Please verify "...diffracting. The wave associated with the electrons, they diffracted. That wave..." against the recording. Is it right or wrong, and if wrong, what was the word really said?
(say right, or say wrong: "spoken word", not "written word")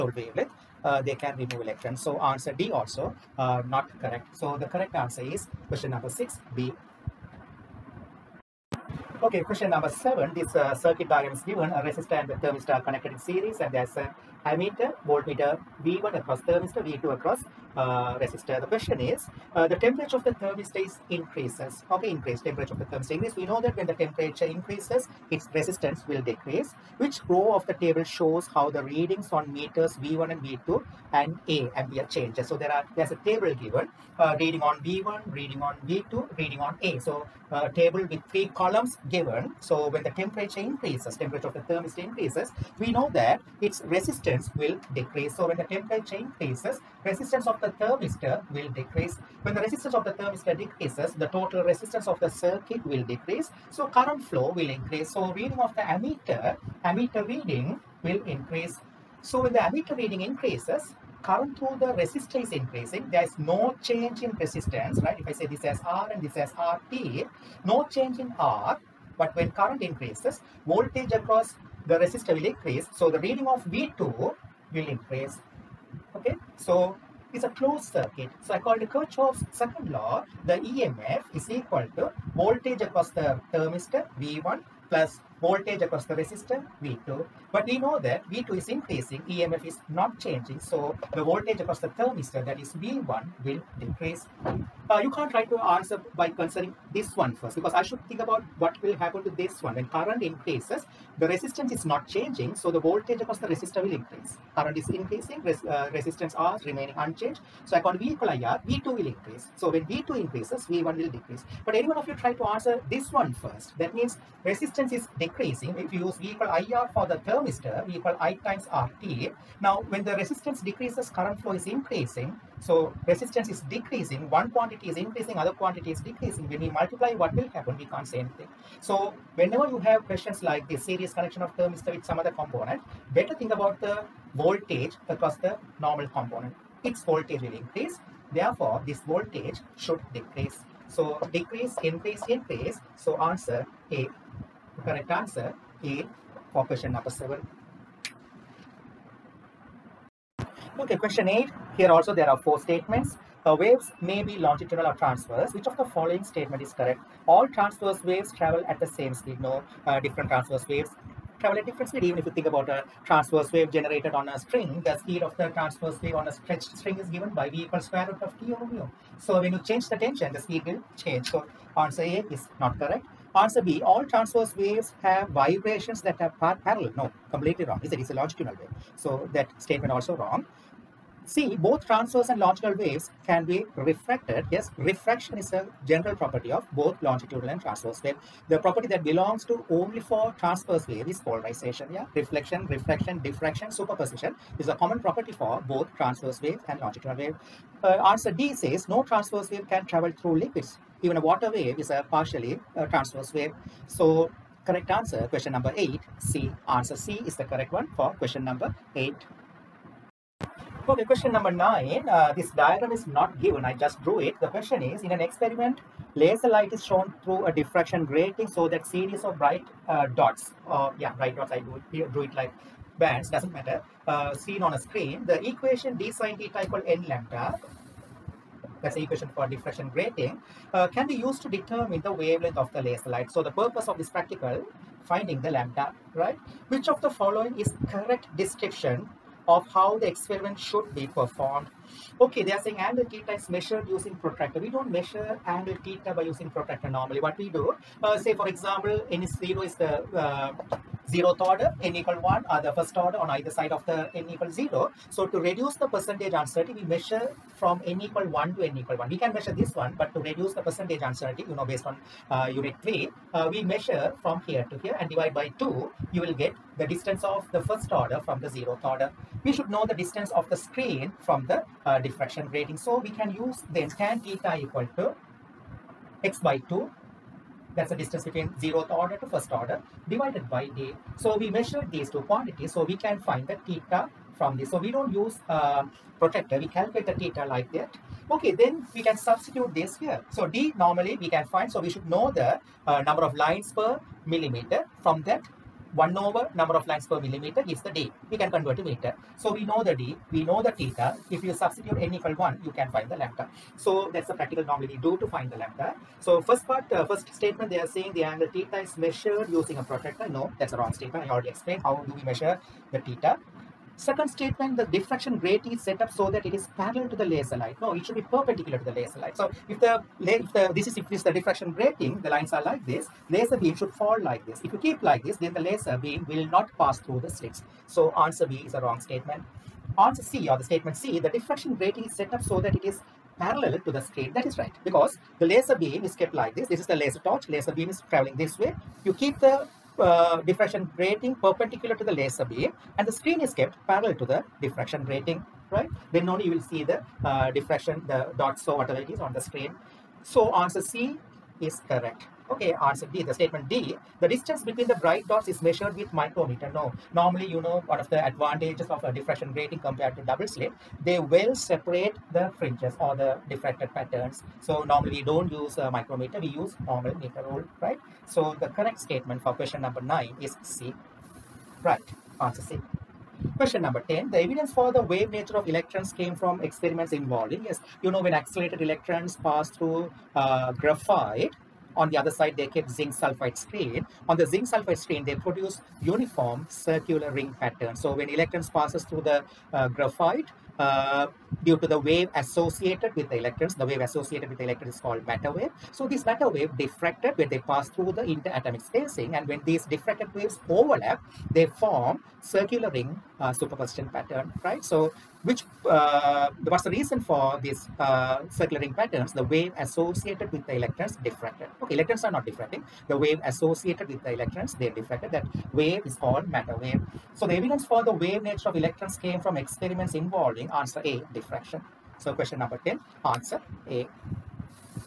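right.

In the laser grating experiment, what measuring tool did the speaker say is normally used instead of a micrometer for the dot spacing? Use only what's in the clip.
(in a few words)
Meter rule.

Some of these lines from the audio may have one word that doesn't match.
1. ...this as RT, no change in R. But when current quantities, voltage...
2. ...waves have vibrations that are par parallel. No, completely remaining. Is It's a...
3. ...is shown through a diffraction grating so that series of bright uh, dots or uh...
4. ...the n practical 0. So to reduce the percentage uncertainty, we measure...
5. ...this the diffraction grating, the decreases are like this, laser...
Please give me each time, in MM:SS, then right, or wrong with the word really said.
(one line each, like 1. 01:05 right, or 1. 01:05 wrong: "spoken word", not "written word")
1. 01:06 wrong: "increases", not "quantities"
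2. 02:54 wrong: "wrong", not "remaining"
3. 03:36 right
4. 04:13 wrong: "equal", not "practical"
5. 05:21 wrong: "lines", not "decreases".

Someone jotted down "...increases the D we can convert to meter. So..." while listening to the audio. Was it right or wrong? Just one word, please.
wrong.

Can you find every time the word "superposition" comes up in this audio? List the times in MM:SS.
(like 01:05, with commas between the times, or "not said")
03:13, 06:43.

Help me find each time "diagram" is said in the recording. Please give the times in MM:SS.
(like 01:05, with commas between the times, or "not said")
00:11, 03:32.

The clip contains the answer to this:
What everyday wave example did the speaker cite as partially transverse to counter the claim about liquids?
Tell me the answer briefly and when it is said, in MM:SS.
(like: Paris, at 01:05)
Water wave, at 03:21.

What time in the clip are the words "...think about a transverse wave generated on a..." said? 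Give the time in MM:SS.
02:42.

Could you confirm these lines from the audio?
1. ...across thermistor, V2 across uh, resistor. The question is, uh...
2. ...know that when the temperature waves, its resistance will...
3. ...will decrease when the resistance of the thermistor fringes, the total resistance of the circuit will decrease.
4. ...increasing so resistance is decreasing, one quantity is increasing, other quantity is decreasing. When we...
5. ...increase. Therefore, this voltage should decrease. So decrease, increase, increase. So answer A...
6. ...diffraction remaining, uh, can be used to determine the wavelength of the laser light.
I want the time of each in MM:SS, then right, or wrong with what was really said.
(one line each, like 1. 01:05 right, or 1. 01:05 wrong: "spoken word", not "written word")
1. 00:16 right
2. 00:23 wrong: "increases", not "waves"
3. 00:48 wrong: "decreases", not "fringes"
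4. 02:01 right
5. 02:17 right
6. 03:49 wrong: "grating", not "remaining".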